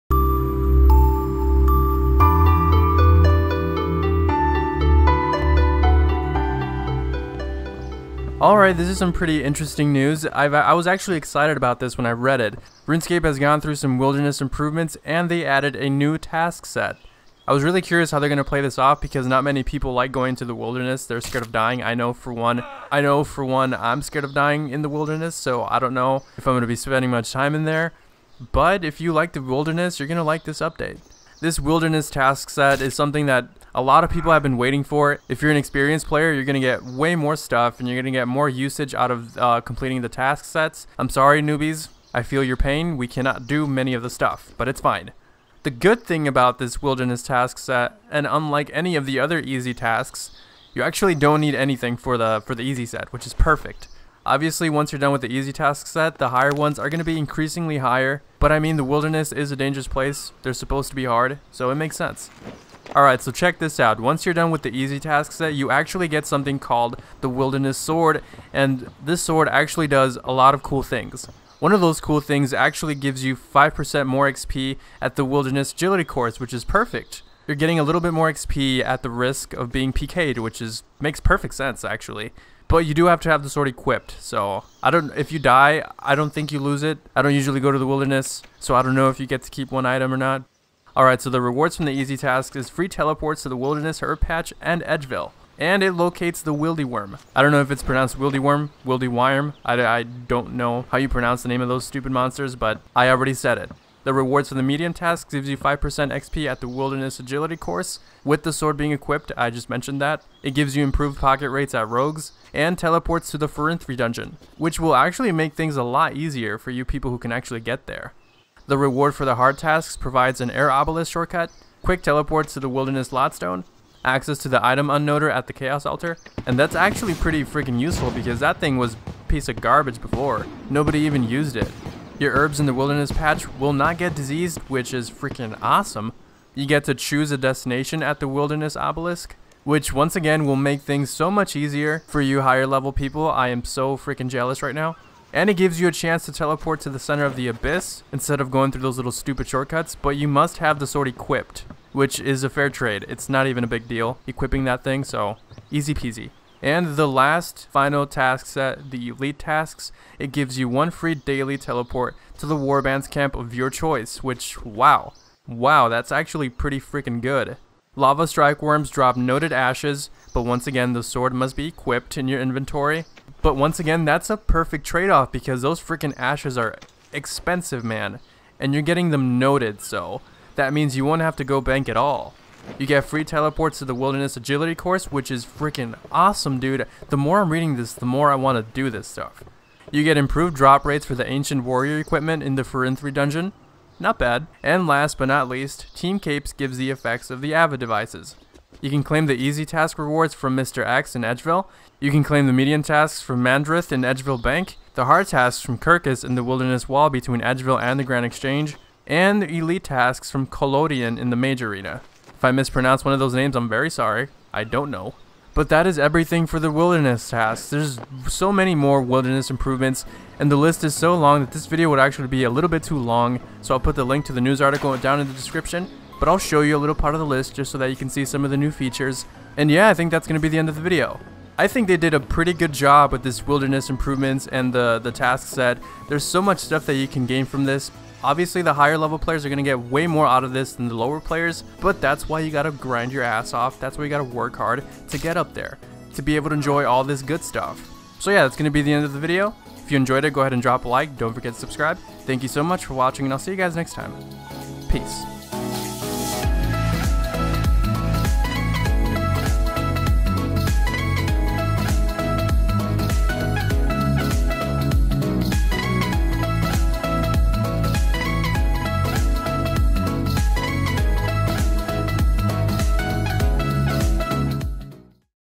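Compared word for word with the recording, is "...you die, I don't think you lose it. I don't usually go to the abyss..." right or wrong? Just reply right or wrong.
wrong.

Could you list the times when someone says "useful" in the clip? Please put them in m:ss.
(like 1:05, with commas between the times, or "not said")
2:07.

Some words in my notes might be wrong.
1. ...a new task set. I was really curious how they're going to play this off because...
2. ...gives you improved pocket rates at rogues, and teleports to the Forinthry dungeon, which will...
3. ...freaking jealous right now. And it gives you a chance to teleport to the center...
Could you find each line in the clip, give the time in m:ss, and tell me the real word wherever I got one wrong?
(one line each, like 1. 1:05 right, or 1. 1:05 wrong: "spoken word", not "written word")
1. 0:15 right
2. 1:50 right
3. 2:23 right.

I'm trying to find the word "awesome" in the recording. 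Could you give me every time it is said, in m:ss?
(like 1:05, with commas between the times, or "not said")
2:15, 3:06.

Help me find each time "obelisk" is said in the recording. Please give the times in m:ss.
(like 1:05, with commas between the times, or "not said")
2:00, 2:18.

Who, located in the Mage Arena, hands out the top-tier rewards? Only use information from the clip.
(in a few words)
Kolodion.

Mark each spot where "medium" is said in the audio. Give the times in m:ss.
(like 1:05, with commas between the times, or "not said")
1:44, 3:22.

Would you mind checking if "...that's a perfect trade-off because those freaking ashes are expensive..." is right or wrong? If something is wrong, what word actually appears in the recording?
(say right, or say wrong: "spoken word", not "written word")
right.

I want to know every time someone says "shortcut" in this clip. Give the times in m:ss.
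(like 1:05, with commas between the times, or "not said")
2:01, 2:29.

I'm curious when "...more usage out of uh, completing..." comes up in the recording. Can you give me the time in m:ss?
0:38.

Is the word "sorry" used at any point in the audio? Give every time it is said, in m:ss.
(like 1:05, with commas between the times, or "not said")
0:41, 3:33.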